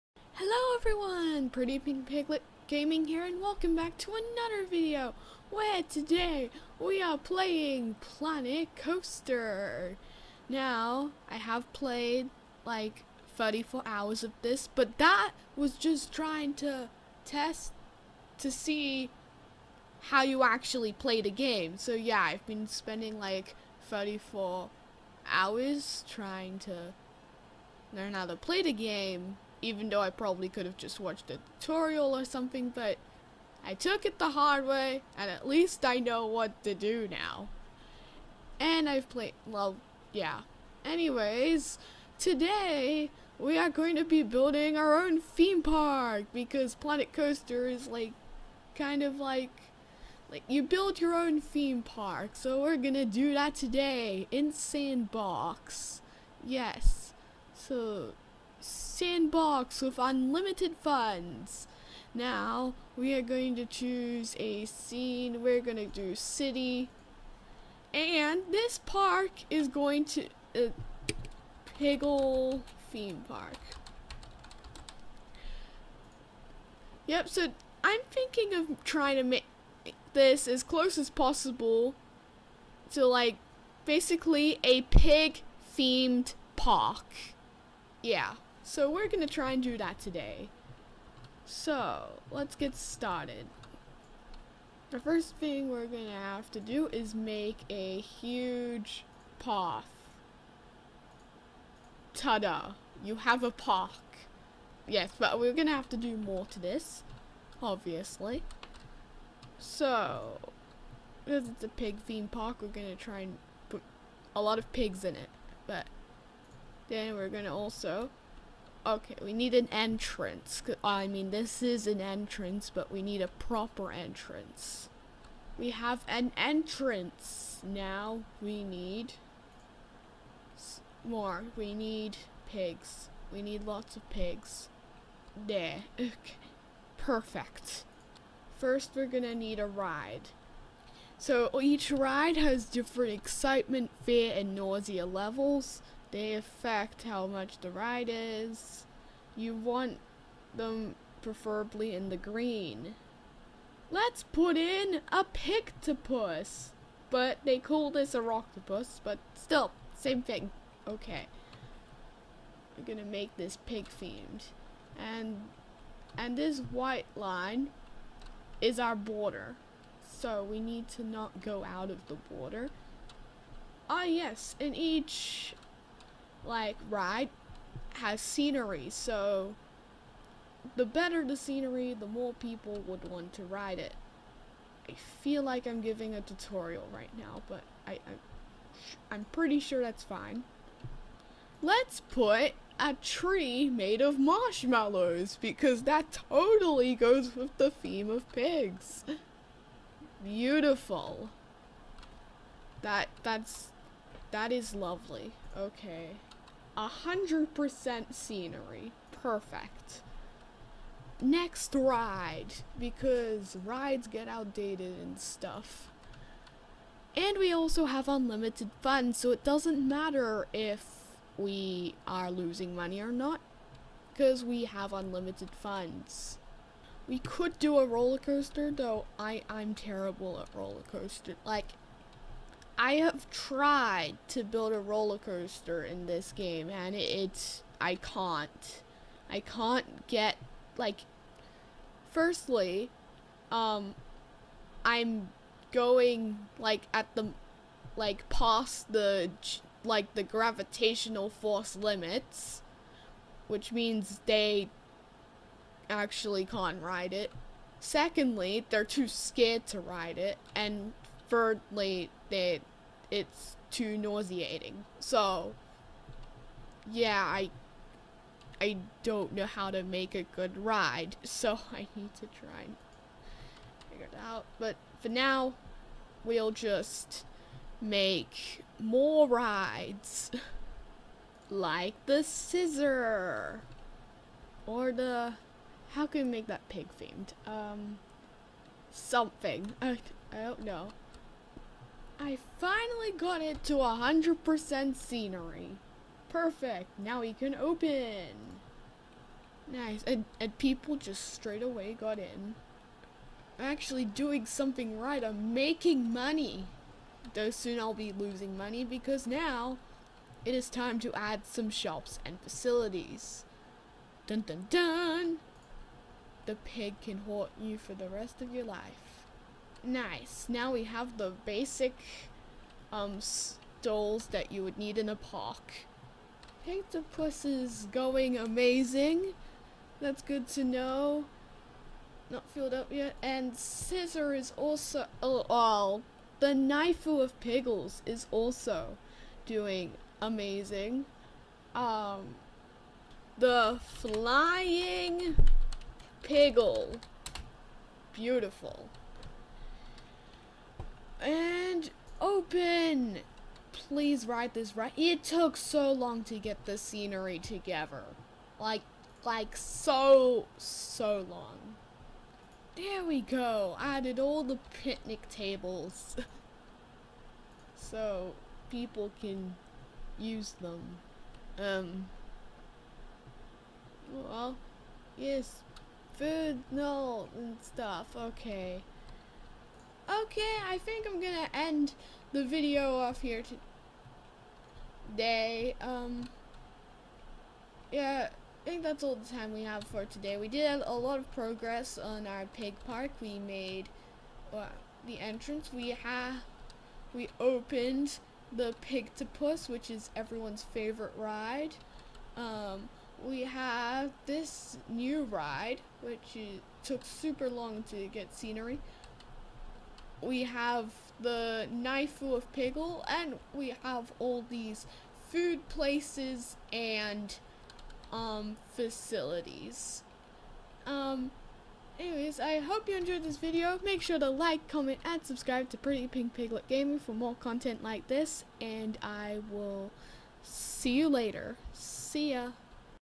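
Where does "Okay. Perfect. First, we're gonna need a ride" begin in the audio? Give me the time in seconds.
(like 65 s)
135 s.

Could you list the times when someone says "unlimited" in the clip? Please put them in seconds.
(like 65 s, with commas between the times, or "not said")
59 s, 218 s, 224 s.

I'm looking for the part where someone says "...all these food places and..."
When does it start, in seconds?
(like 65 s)
414 s.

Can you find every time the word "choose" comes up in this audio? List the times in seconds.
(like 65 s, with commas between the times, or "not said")
63 s.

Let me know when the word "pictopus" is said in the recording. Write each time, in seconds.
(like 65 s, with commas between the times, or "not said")
155 s, 326 s.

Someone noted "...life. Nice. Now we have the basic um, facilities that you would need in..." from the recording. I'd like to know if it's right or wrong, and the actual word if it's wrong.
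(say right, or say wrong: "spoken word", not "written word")
wrong: "stoles", not "facilities".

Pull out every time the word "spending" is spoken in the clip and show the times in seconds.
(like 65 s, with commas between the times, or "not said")
22 s.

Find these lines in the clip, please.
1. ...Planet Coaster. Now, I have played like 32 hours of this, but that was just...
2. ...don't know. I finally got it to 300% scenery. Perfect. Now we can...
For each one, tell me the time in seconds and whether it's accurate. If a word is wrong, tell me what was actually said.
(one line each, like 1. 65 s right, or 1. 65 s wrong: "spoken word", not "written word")
1. 8 s wrong: "34", not "32"
2. 290 s wrong: "100", not "300".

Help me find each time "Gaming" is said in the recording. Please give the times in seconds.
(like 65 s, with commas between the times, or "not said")
2 s, 426 s.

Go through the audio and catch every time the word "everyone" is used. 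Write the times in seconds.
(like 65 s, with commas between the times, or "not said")
0 s, 400 s.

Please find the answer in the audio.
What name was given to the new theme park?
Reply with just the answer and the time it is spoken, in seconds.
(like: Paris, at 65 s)
Piggle theme park, at 71 s.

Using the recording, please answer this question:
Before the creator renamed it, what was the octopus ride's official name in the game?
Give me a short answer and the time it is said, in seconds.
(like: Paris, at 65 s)
Rocktopus, at 158 s.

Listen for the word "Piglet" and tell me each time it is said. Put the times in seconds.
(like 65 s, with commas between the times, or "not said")
2 s, 426 s.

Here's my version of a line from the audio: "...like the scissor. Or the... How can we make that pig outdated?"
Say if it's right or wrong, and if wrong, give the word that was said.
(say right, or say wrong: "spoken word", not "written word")
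wrong: "themed", not "outdated".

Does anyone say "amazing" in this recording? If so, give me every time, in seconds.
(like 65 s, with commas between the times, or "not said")
328 s, 340 s.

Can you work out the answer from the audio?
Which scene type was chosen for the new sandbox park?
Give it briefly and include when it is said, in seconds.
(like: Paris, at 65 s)
City, at 66 s.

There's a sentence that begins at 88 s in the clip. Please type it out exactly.
So we're going to try and do that today.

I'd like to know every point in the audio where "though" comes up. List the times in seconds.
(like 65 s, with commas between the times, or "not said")
29 s, 228 s, 307 s.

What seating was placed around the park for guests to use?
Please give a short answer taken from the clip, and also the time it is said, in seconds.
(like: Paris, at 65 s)
Picnic tables, at 364 s.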